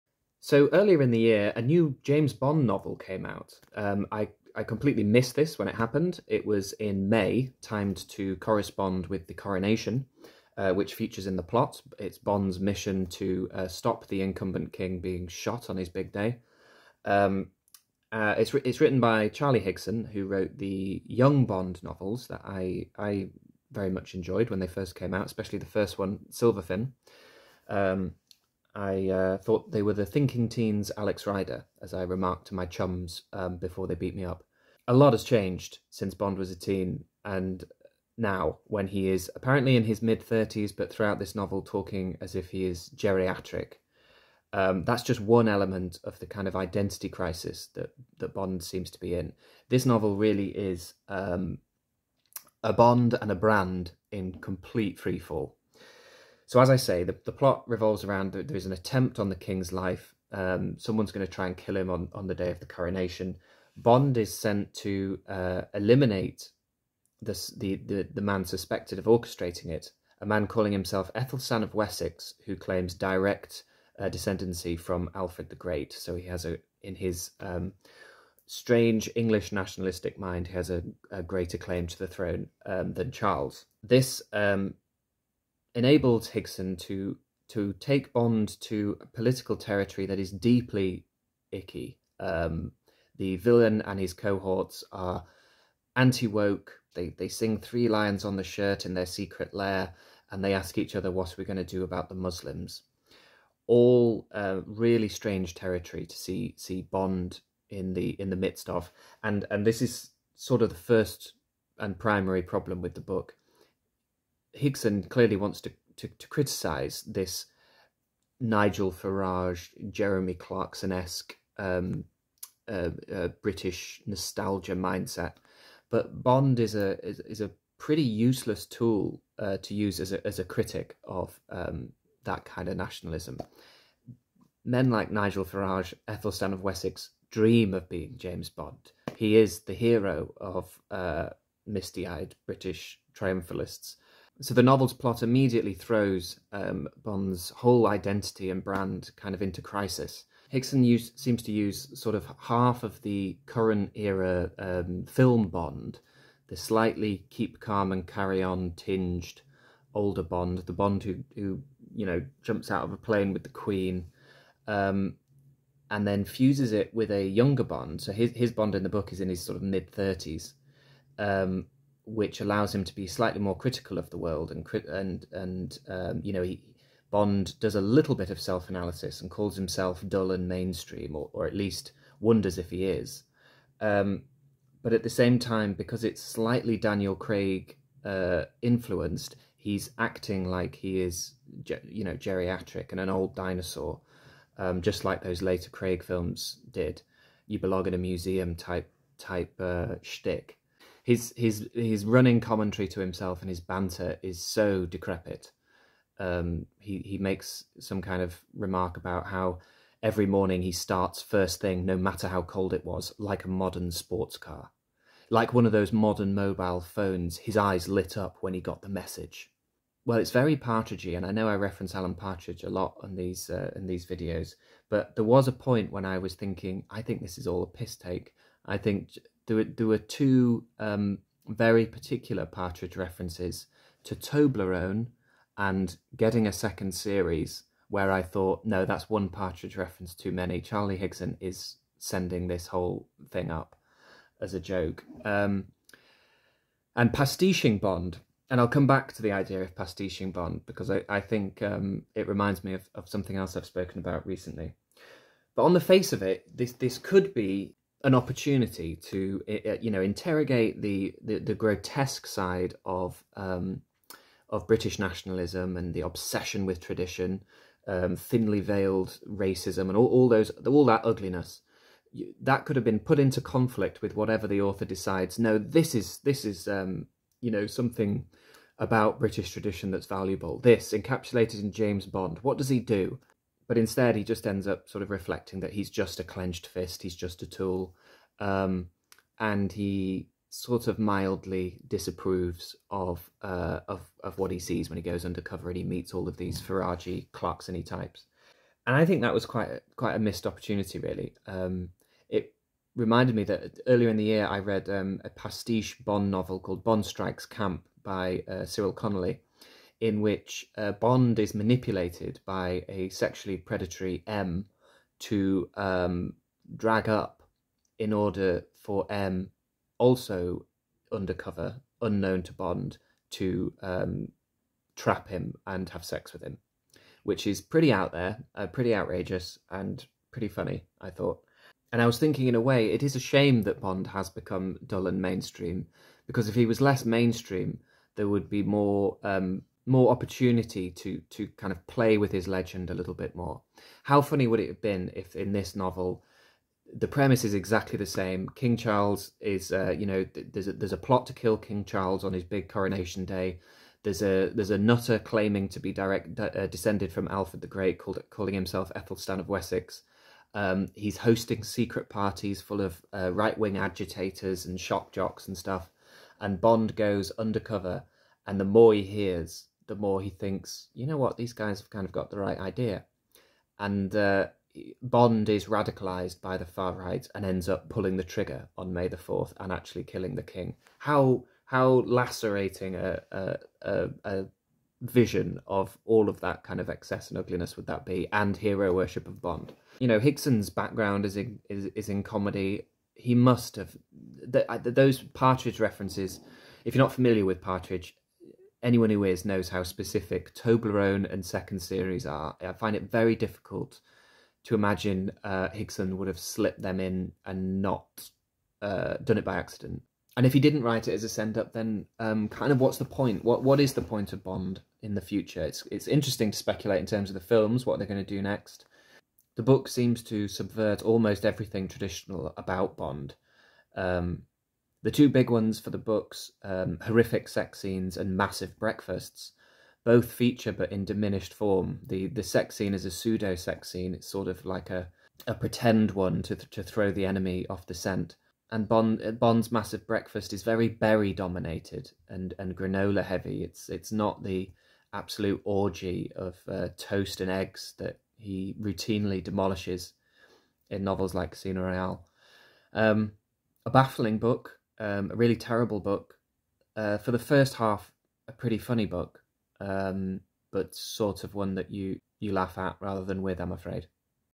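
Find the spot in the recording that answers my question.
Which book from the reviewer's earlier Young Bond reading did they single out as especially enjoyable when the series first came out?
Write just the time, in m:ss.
0:26.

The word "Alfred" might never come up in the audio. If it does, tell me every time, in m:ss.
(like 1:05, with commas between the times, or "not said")
1:15, 5:57.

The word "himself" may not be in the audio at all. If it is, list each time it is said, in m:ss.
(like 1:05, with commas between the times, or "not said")
1:10, 2:59, 3:22, 5:58.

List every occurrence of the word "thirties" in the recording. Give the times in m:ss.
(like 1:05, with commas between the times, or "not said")
2:49.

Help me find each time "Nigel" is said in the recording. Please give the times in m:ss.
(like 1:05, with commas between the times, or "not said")
1:58, 2:15.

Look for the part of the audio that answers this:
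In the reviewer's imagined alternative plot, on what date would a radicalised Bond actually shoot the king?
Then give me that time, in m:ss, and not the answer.
6:18.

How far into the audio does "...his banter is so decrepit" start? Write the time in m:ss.
3:23.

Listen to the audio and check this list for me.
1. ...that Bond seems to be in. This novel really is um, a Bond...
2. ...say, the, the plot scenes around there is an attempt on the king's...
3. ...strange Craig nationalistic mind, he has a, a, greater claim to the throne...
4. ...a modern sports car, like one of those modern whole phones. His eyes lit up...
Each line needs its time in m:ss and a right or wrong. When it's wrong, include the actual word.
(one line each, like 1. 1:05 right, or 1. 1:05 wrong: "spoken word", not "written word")
1. 0:48 right
2. 0:56 wrong: "revolves", not "scenes"
3. 1:18 wrong: "English", not "Craig"
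4. 3:33 wrong: "mobile", not "whole".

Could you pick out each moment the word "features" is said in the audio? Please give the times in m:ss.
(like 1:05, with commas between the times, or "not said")
0:10, 7:10.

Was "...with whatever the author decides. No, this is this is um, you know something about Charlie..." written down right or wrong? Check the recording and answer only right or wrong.
wrong.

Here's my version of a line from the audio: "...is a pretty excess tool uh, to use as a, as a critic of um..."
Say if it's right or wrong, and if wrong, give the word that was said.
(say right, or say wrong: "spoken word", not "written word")
wrong: "useless", not "excess".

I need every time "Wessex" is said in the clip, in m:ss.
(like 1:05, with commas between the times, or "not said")
1:11, 2:16, 5:59.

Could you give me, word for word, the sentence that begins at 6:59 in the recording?
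The book seems to subvert almost everything traditional about Bond.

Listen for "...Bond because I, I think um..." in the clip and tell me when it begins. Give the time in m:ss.
4:10.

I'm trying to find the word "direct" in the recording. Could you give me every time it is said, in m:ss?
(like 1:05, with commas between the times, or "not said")
1:12, 5:55.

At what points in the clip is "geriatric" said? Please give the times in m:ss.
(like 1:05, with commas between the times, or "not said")
0:42, 3:12.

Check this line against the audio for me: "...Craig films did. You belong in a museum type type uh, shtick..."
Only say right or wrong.
right.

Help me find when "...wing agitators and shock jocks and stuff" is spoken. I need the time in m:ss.
6:03.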